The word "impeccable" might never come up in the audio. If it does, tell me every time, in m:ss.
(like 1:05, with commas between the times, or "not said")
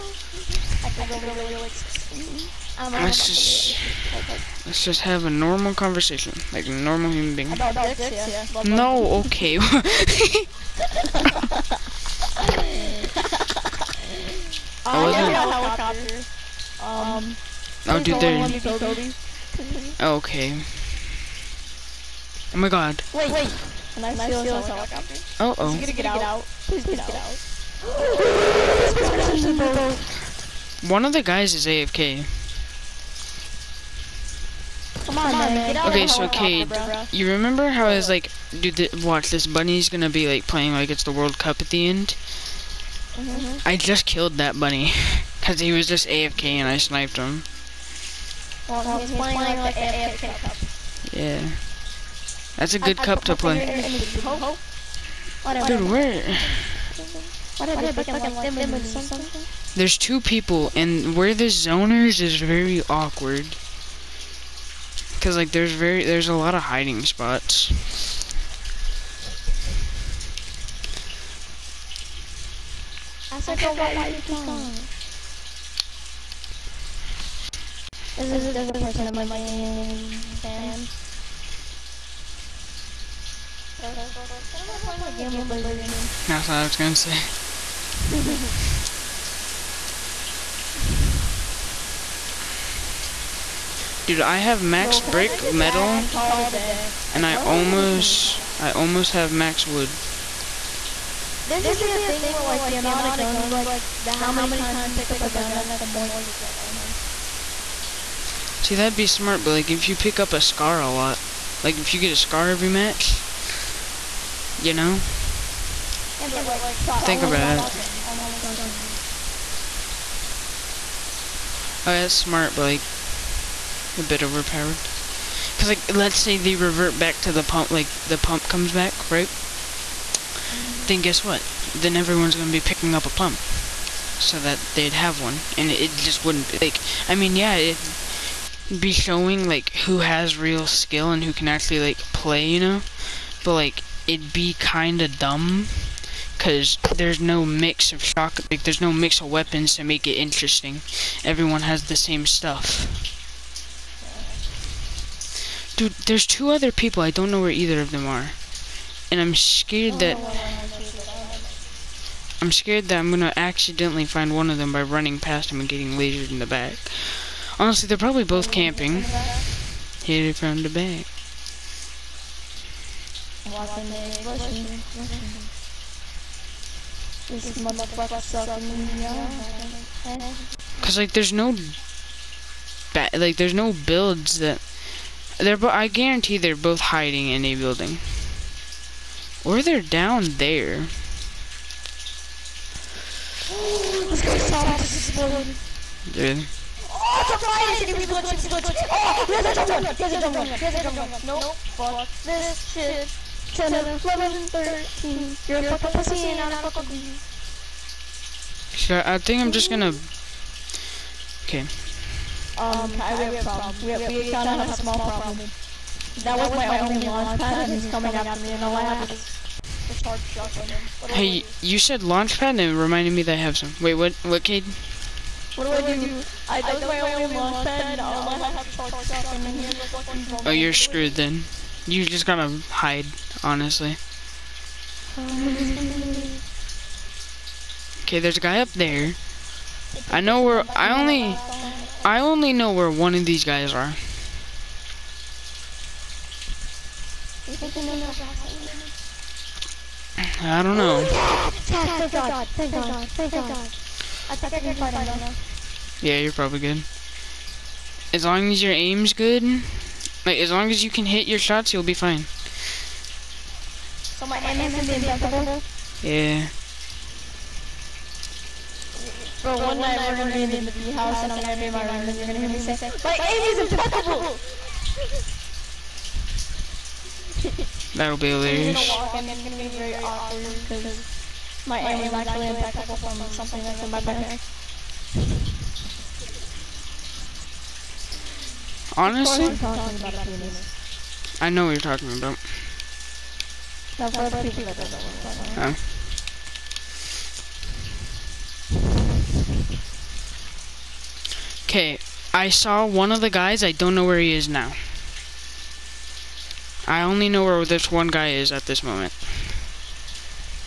4:33, 4:42.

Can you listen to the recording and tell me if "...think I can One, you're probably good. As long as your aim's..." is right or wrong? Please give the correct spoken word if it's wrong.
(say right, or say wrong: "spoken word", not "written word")
wrong: "Yeah", not "One".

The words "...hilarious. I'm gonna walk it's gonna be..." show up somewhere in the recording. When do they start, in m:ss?
4:38.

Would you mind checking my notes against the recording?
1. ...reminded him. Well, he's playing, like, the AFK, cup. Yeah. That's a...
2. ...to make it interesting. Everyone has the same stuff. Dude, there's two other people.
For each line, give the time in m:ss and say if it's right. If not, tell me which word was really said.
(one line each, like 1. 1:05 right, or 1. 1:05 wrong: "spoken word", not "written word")
1. 0:46 wrong: "sniped", not "reminded"
2. 2:29 right.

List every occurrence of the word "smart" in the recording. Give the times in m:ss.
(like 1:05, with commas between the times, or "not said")
1:49, 2:02.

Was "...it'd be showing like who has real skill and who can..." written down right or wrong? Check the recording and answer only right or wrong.
right.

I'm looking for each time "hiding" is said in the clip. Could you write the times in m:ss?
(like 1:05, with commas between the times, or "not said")
1:06, 3:06.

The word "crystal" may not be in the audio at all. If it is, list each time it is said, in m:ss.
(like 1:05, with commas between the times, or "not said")
not said.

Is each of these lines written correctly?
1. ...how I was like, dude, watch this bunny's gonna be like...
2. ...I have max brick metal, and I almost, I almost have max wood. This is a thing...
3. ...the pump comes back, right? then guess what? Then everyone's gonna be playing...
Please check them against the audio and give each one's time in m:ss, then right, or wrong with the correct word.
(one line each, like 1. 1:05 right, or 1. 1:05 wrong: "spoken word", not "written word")
1. 0:37 right
2. 1:34 right
3. 2:08 wrong: "picking", not "playing".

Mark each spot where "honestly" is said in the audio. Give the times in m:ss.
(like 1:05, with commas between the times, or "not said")
2:47, 3:53, 4:48.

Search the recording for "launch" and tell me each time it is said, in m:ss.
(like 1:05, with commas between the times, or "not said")
3:37, 3:42, 3:47.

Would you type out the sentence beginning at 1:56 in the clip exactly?
Yeah, but, but, like, Think about it.